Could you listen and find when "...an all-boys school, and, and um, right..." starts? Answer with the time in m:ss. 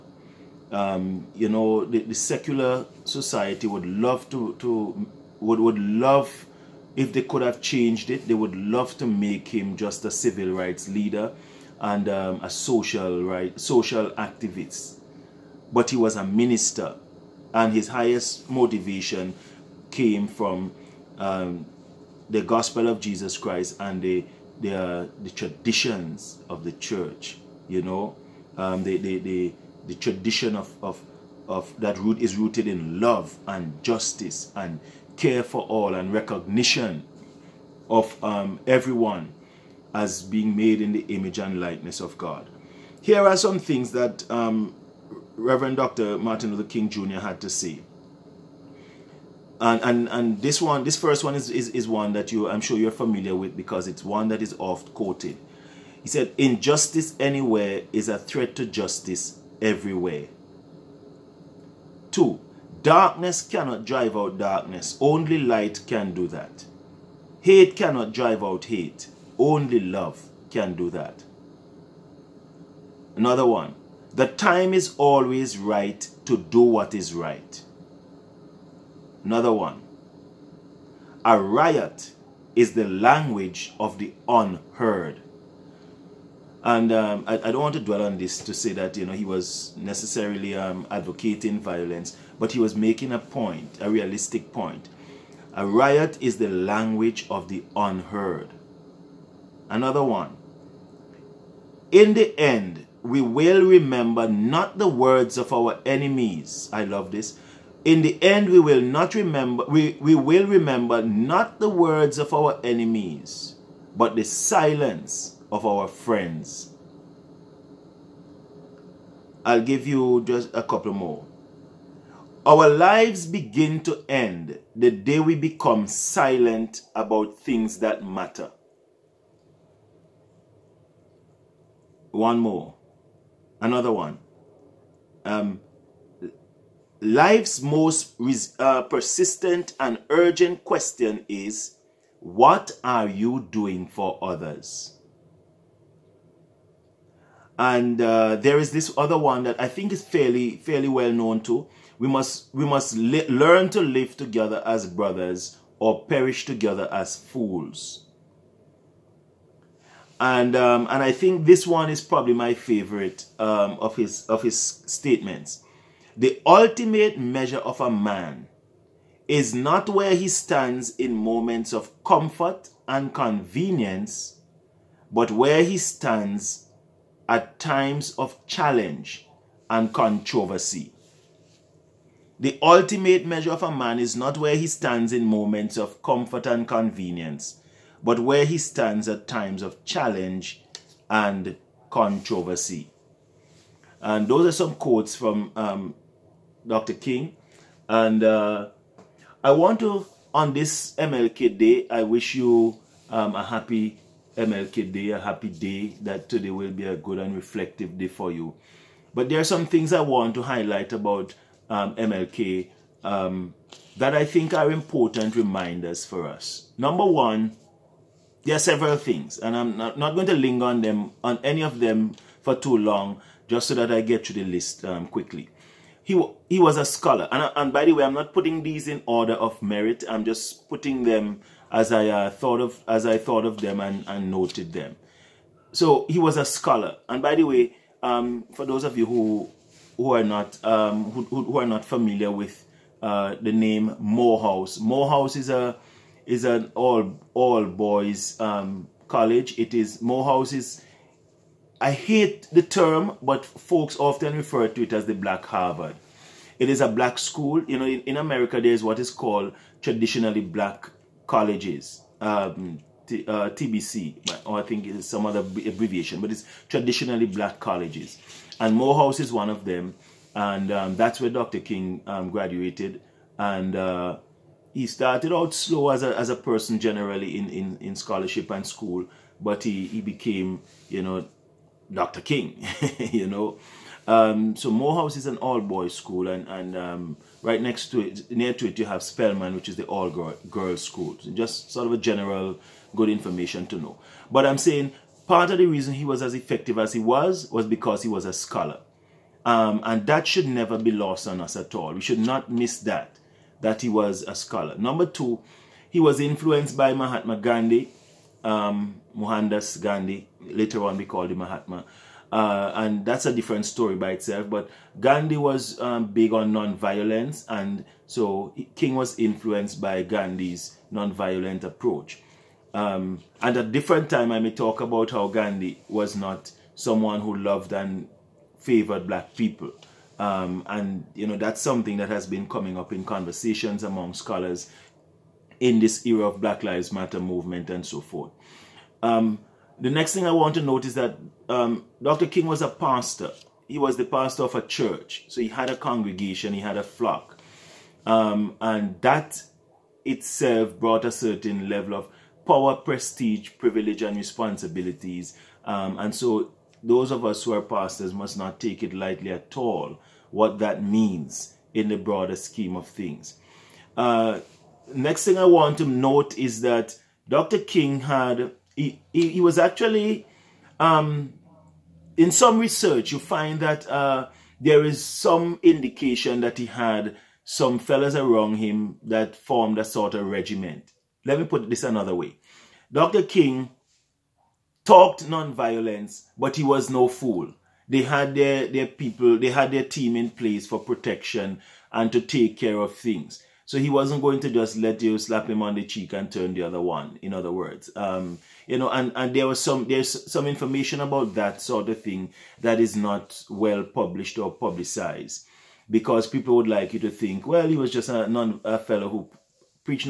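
4:45.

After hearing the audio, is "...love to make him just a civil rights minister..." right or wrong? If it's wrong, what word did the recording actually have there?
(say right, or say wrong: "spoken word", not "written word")
wrong: "leader", not "minister".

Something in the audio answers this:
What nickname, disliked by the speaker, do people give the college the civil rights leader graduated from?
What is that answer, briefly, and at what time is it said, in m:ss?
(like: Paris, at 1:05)
the Black Harvard, at 4:15.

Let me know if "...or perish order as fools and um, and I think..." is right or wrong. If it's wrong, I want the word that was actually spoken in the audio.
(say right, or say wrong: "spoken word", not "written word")
wrong: "together", not "order".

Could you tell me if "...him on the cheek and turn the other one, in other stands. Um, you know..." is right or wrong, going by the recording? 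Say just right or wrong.
wrong.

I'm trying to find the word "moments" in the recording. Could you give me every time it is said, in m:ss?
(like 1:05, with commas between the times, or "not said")
2:51, 3:05.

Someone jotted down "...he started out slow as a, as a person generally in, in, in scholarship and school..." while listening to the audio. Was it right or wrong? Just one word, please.
right.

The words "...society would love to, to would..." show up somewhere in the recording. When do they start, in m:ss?
0:03.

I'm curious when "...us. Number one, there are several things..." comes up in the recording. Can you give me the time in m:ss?
3:36.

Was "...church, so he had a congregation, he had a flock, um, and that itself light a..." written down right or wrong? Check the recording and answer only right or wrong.
wrong.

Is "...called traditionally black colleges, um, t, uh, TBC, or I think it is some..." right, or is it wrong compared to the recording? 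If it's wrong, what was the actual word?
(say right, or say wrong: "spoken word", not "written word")
right.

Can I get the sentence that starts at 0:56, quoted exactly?
He said, Injustice anywhere is a threat to justice everywhere.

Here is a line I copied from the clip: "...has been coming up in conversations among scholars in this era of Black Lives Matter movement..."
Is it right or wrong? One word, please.
right.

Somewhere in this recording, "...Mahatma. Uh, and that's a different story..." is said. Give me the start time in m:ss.
5:11.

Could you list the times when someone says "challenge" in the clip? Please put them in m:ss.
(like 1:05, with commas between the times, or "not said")
2:58, 3:09.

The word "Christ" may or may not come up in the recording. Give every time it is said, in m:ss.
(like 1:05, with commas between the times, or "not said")
0:23.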